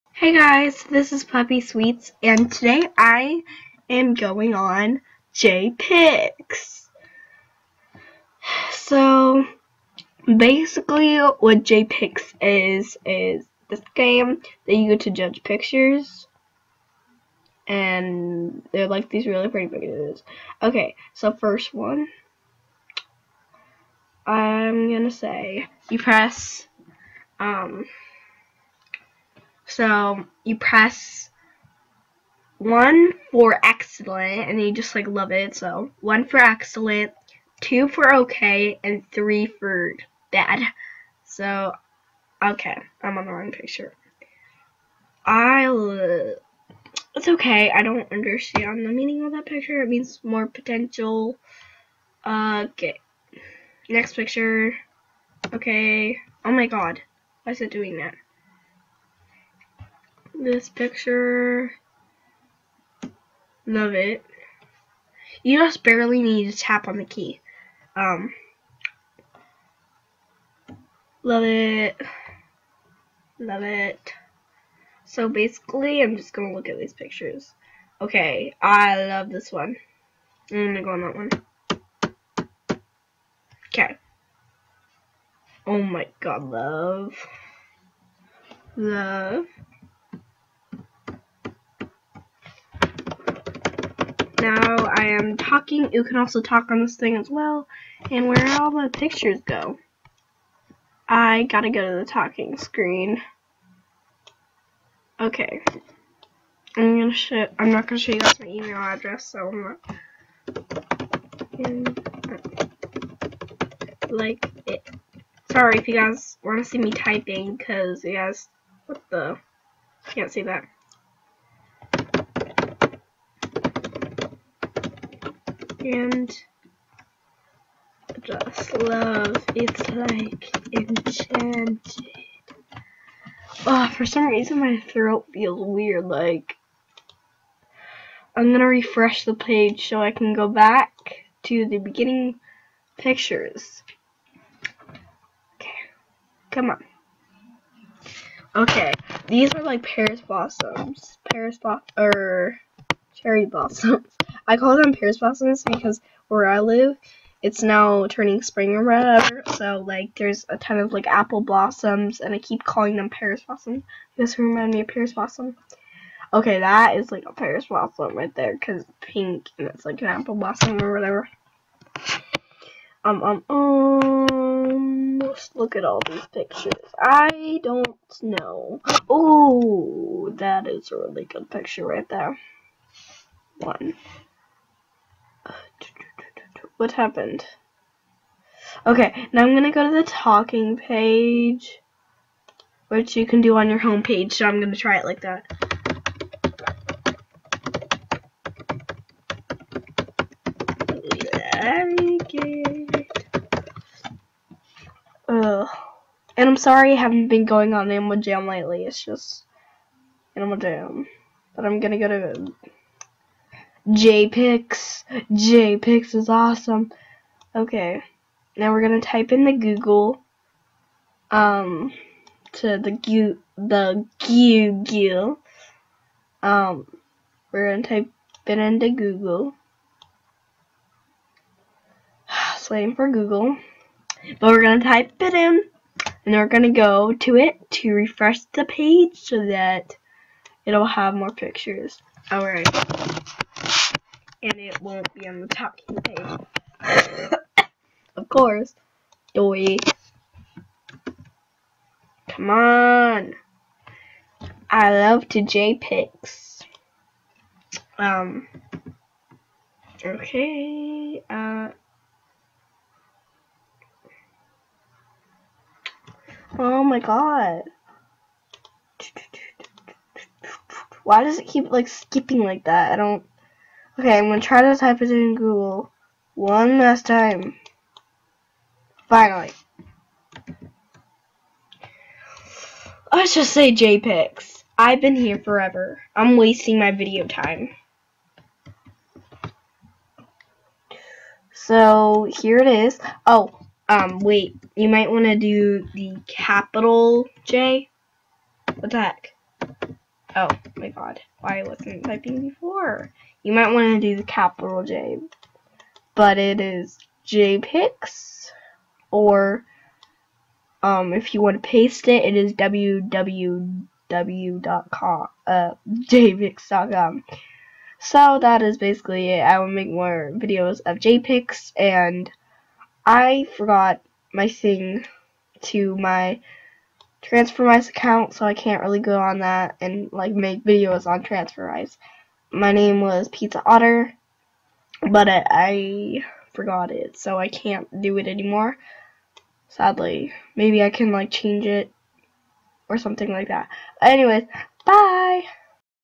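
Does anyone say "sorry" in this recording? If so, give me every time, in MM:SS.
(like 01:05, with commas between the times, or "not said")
01:55, 03:26.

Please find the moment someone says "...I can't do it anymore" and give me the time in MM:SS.
05:37.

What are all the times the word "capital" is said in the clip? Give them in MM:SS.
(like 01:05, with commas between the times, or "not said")
04:56, 05:04.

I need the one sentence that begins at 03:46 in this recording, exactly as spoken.
Um we're gonna type it into Google.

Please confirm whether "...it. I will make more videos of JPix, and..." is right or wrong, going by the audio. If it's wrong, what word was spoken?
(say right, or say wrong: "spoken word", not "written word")
right.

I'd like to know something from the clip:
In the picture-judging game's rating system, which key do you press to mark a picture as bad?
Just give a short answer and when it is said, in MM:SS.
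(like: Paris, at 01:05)
3, at 00:39.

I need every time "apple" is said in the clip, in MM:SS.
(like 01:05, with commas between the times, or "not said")
02:41, 02:50.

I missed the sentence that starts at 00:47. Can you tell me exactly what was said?
I don't understand the meaning of that picture.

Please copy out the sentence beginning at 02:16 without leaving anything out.
Like I'm gonna refresh the page so I can go back to the beginning pictures.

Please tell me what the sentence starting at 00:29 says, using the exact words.
So you press one for excellent, and you just like love it.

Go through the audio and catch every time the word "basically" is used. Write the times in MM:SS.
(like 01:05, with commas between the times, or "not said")
00:10, 01:15, 05:18.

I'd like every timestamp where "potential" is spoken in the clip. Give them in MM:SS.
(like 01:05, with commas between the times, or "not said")
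00:50.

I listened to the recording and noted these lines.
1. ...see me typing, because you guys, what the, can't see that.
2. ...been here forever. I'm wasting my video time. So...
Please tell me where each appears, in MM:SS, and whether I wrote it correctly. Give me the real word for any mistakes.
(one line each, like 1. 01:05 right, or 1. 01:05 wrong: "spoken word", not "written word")
1. 01:56 right
2. 04:45 right.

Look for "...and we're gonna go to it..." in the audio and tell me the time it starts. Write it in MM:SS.
03:56.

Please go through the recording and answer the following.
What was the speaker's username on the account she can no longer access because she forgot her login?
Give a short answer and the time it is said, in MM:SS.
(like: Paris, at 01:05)
Pizza Otter, at 05:33.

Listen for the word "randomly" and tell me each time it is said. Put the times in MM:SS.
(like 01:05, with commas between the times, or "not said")
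not said.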